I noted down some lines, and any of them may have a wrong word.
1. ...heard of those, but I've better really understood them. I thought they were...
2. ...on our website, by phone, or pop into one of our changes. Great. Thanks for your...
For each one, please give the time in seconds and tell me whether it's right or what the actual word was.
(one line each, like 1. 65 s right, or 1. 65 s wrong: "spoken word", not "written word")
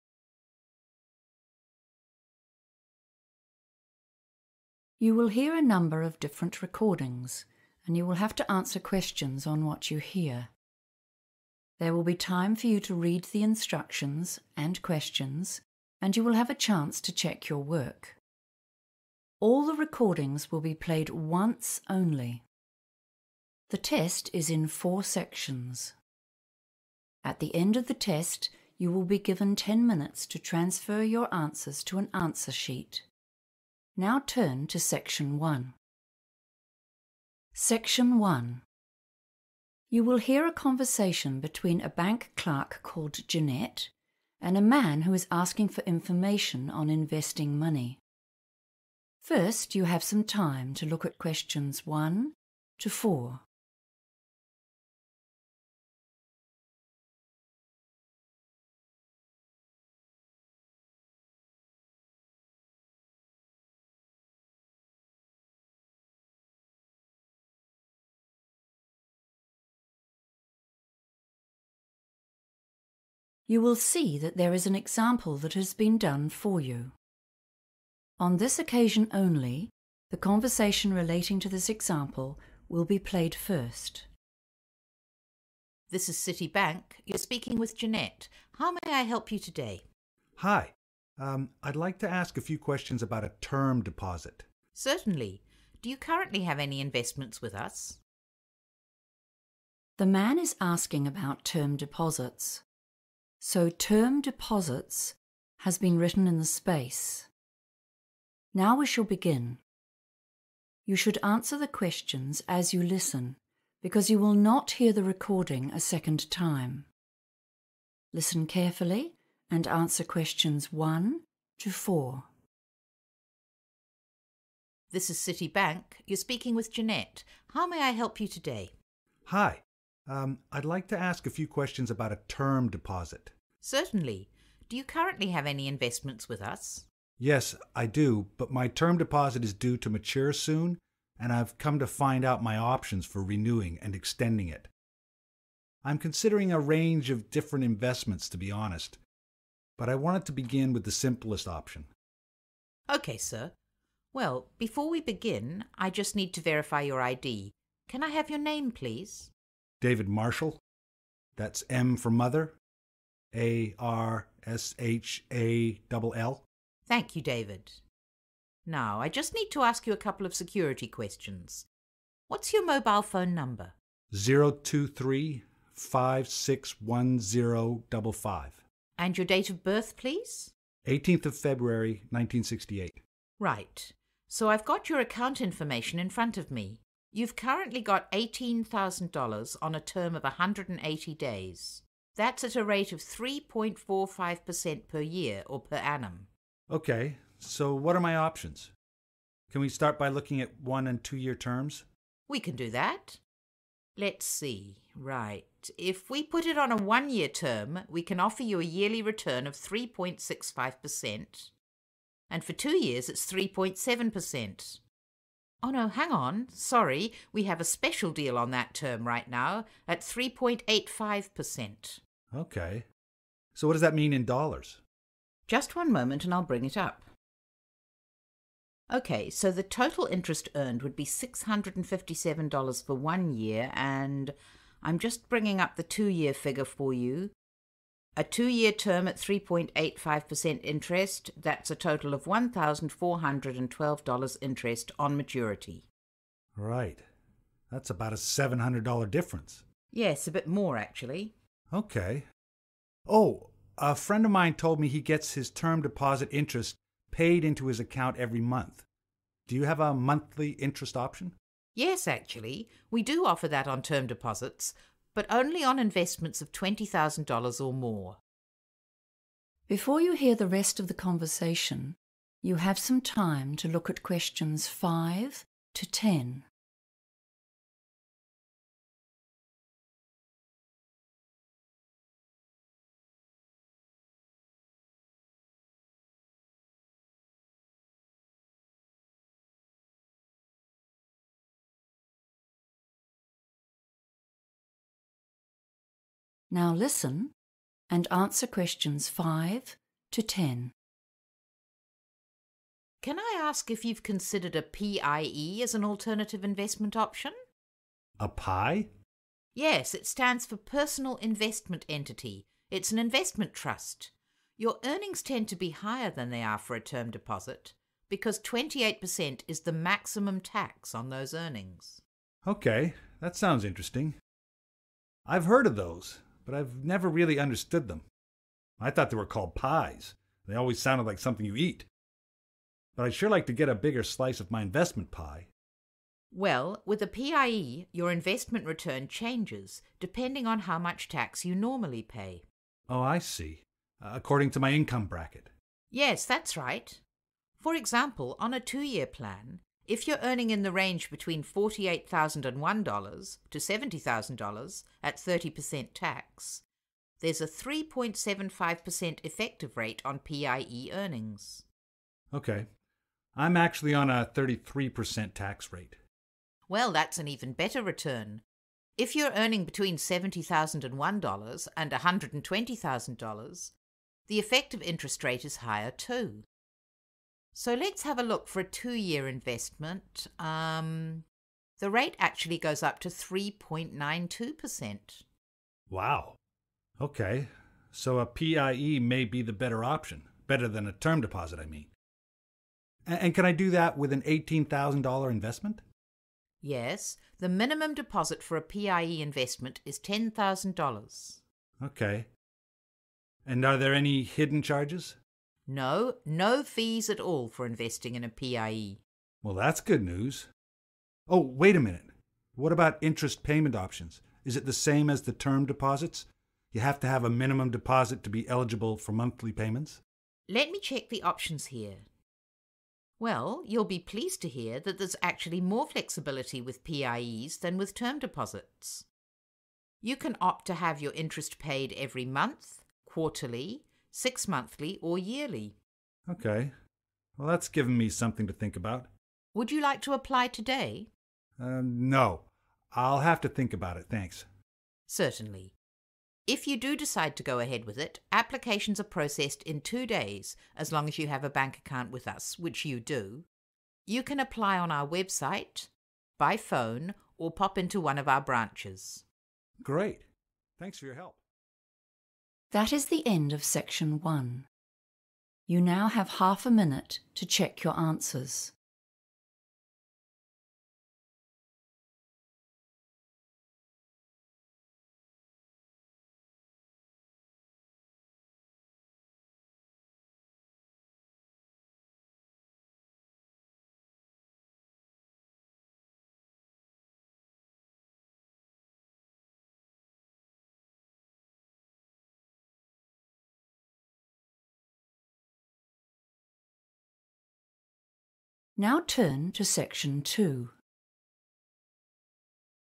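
1. 325 s wrong: "never", not "better"
2. 454 s wrong: "branches", not "changes".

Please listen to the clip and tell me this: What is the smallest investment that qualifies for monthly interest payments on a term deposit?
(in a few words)
$20,000.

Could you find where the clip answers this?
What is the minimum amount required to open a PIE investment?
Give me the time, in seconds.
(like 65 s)
399 s.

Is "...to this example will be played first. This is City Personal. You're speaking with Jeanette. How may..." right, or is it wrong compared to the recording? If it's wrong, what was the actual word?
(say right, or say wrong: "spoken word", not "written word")
wrong: "Bank", not "Personal".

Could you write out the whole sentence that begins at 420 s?
Let me check the options here.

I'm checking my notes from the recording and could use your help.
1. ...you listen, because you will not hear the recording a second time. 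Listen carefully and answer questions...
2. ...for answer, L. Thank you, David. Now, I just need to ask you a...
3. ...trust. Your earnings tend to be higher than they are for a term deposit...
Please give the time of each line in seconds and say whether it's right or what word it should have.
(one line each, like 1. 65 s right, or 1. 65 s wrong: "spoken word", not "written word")
1. 112 s right
2. 161 s wrong: "mother", not "answer"
3. 313 s right.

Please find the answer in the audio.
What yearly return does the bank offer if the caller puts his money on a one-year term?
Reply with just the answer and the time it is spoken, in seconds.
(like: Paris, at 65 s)
3.65%, at 209 s.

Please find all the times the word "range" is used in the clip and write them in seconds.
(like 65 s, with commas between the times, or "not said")
146 s.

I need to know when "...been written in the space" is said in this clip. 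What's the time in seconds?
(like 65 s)
105 s.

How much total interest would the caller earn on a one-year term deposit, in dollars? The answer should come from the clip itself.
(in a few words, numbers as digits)
$657.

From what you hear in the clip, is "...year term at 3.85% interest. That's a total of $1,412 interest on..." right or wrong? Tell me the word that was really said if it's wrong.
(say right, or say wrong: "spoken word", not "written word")
right.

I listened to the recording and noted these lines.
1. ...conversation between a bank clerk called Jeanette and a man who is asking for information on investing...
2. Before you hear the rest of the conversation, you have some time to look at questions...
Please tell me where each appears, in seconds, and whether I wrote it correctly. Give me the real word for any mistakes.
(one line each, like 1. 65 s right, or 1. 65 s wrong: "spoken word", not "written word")
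1. 40 s right
2. 269 s right.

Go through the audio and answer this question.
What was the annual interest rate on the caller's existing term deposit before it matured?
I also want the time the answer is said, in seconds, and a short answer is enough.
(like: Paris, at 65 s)
3.45%, at 193 s.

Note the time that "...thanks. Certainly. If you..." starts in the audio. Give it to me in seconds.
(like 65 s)
444 s.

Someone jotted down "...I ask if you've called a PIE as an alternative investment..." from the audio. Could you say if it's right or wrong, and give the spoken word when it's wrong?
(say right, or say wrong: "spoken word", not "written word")
wrong: "considered", not "called".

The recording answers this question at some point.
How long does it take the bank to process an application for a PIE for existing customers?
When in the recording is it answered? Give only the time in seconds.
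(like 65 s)
449 s.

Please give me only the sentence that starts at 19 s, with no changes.
All the recordings will be played once only.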